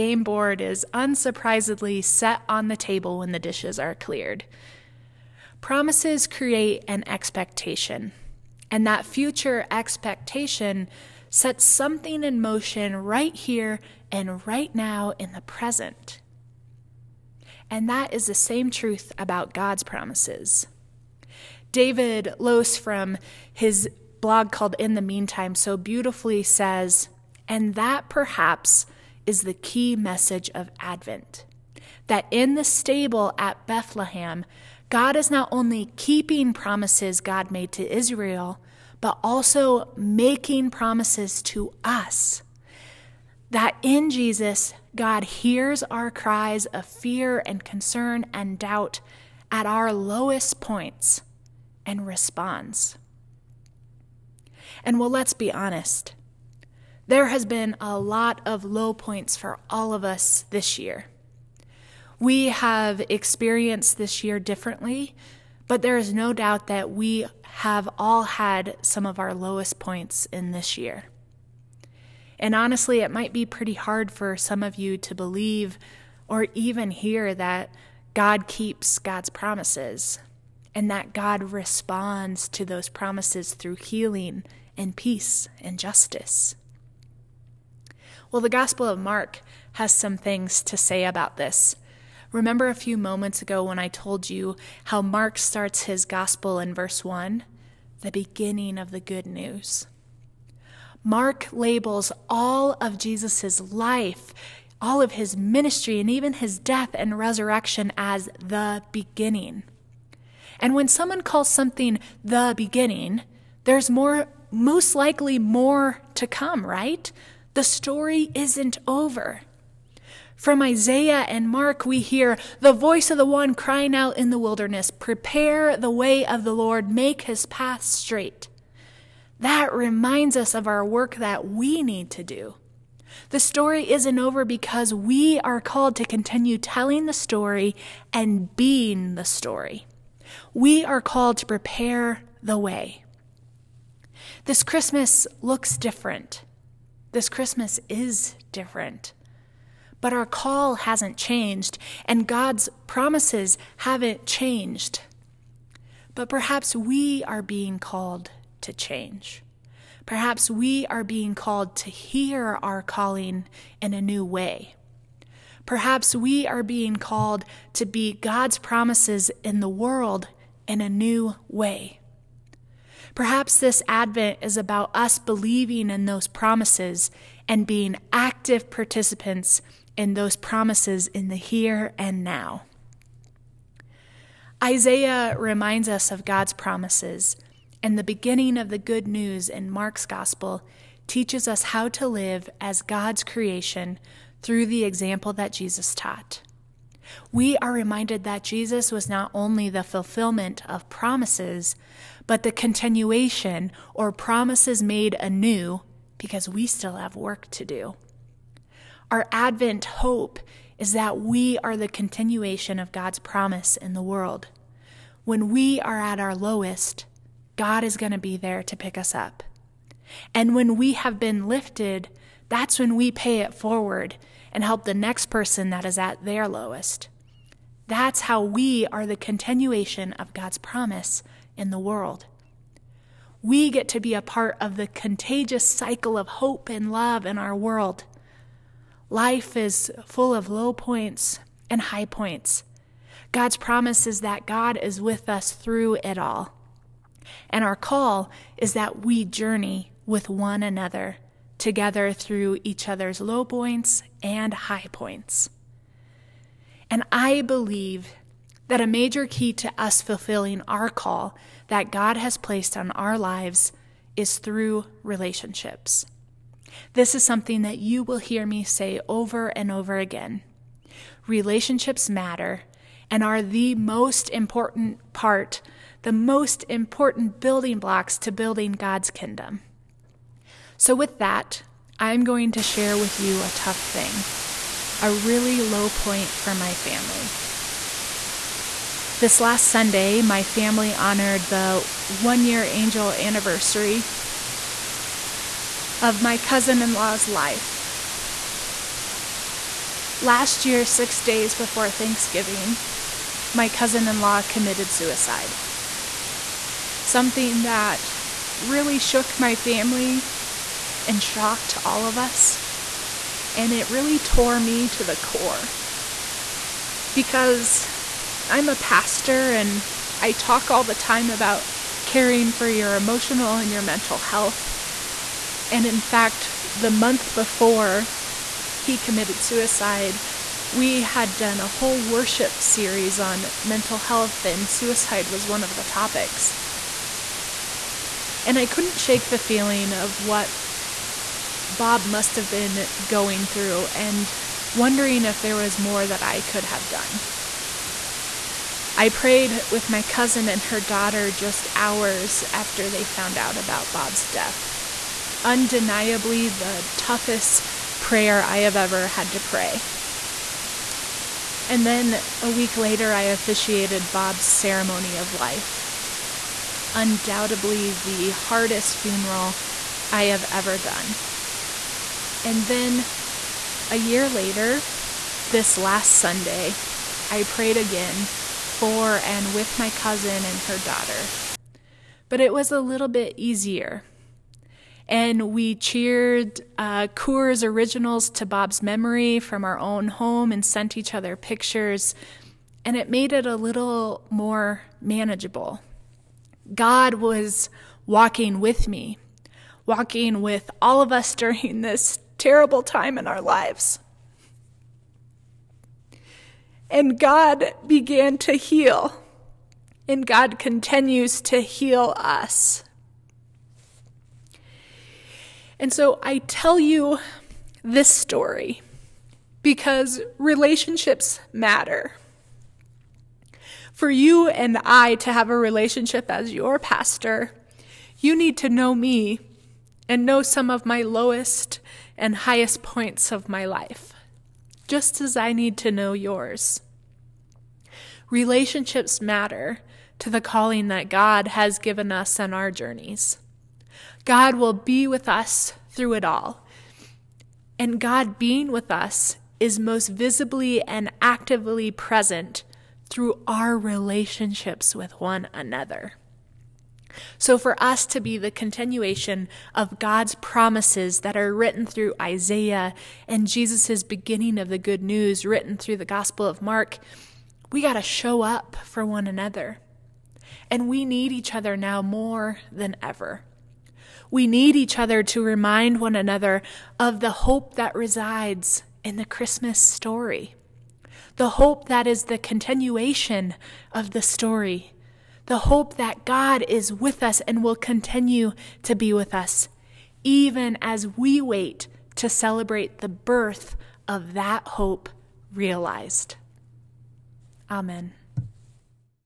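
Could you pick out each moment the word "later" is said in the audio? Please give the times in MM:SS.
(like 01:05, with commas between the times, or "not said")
06:02, 06:14.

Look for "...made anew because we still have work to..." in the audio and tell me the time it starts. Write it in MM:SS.
03:24.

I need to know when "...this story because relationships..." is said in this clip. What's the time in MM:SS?
06:57.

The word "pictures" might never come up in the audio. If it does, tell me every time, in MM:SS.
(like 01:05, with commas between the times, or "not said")
06:31.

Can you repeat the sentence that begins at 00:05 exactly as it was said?
Promises create an expectation, and that future expectation sets something in motion right here and right now in the present.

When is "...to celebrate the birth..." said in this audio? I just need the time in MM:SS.
08:12.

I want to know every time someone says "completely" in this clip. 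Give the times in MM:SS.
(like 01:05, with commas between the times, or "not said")
not said.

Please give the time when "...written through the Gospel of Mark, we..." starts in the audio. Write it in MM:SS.
07:45.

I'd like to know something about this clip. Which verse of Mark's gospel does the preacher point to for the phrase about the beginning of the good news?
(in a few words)
Verse 1.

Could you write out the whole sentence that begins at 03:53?
We get to be a part of the contagious cycle of hope and love in our world.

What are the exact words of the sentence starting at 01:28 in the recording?
Well, the Gospel of Mark has some things to say about this.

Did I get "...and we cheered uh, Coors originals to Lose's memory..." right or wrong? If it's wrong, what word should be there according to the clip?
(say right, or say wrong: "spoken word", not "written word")
wrong: "Bob", not "Lose".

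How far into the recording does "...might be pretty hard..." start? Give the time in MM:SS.
01:13.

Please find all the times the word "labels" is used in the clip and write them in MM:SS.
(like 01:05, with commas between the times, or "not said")
01:41.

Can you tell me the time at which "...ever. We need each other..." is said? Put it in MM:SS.
07:53.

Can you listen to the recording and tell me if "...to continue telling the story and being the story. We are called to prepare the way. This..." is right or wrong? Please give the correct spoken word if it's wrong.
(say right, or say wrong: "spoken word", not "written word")
right.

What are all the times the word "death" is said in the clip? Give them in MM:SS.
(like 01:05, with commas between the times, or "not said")
01:46, 05:54.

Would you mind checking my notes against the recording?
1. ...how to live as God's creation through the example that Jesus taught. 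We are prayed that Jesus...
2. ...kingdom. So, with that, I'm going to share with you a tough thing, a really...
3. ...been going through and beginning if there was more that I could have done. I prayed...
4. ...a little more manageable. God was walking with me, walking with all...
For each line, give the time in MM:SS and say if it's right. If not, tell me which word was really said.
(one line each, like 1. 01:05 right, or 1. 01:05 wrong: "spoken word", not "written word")
1. 03:11 wrong: "reminded", not "prayed"
2. 04:39 right
3. 05:42 wrong: "wondering", not "beginning"
4. 06:33 right.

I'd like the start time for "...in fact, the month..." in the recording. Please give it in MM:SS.
05:25.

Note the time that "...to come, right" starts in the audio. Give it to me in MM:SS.
01:56.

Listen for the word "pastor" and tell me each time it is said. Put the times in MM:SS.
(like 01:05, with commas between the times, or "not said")
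05:18, 07:06.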